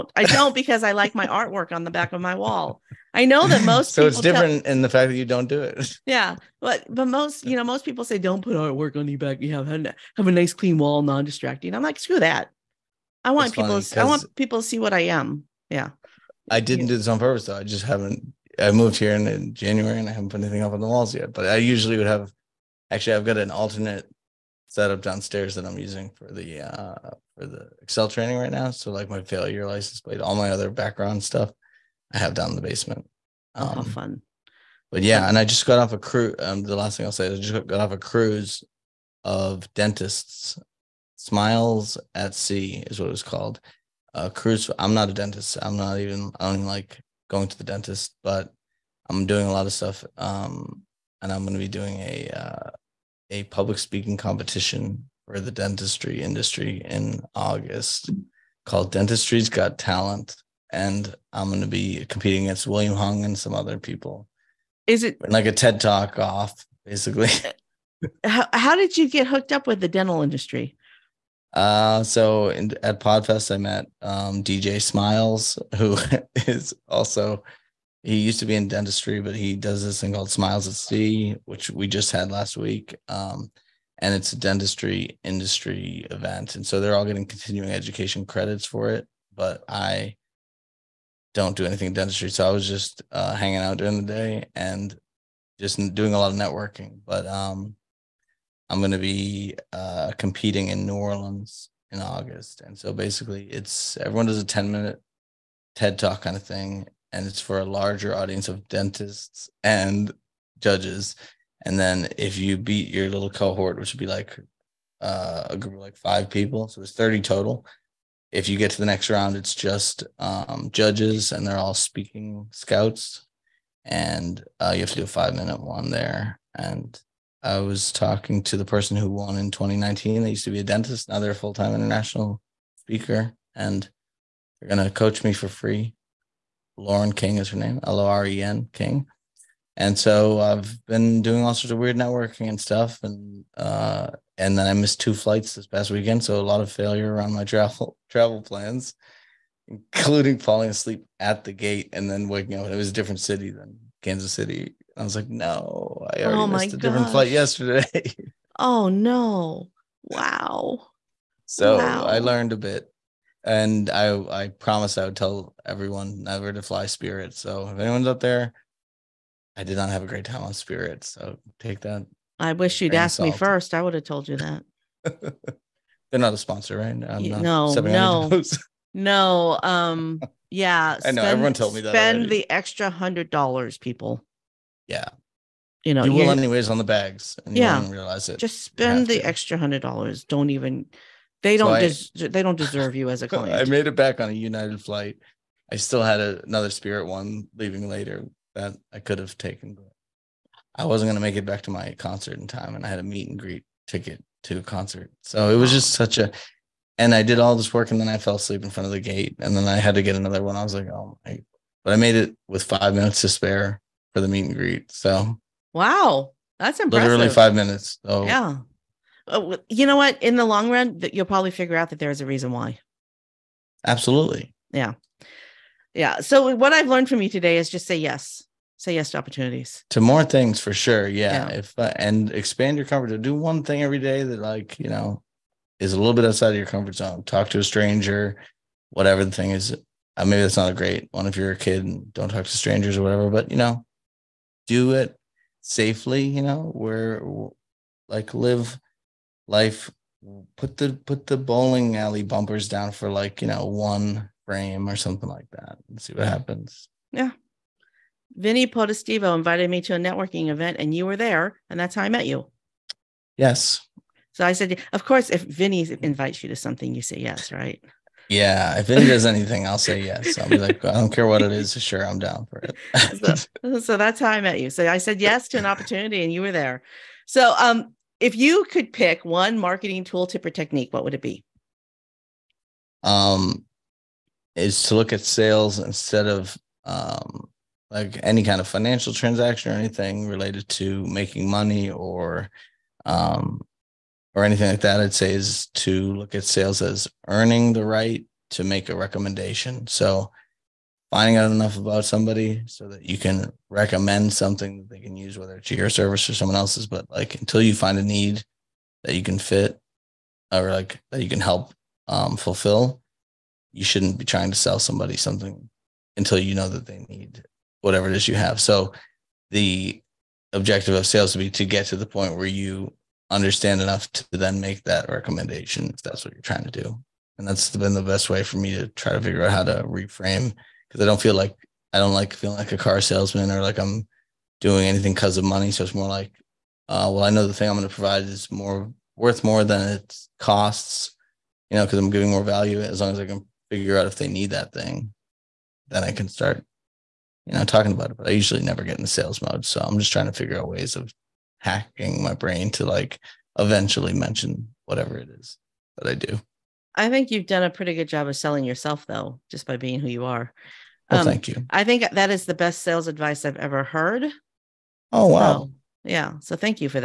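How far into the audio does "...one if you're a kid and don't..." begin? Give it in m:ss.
4:01.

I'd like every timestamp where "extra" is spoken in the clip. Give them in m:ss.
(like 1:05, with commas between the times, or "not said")
3:02, 3:09.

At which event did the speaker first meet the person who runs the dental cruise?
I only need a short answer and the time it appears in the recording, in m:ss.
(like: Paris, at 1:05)
Podfest, at 1:12.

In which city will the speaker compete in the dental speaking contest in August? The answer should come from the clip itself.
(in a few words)
New Orleans.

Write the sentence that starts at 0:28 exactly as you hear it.
So like my failure license plate, all my other background stuff I have down in the basement.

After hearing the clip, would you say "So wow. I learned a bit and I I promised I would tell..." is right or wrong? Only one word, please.
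right.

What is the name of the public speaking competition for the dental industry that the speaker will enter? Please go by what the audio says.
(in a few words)
Dentistry's Got Talent.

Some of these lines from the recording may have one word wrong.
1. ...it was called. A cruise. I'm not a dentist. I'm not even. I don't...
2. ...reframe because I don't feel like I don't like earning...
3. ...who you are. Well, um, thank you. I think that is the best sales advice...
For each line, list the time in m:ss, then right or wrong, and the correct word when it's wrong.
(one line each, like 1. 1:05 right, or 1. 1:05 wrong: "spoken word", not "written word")
1. 0:43 right
2. 5:29 wrong: "feeling", not "earning"
3. 5:59 right.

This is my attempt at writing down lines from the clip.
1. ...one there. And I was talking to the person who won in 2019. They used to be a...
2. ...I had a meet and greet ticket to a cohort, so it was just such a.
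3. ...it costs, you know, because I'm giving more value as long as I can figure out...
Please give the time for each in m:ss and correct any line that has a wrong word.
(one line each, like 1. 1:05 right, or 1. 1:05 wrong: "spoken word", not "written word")
1. 2:05 right
2. 3:22 wrong: "concert", not "cohort"
3. 5:39 right.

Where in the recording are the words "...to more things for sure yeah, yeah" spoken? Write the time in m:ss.
3:49.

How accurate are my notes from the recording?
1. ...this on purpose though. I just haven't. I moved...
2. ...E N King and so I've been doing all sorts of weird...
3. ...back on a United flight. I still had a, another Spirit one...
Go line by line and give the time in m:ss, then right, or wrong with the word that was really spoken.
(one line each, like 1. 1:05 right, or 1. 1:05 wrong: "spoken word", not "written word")
1. 0:16 right
2. 2:18 right
3. 3:13 right.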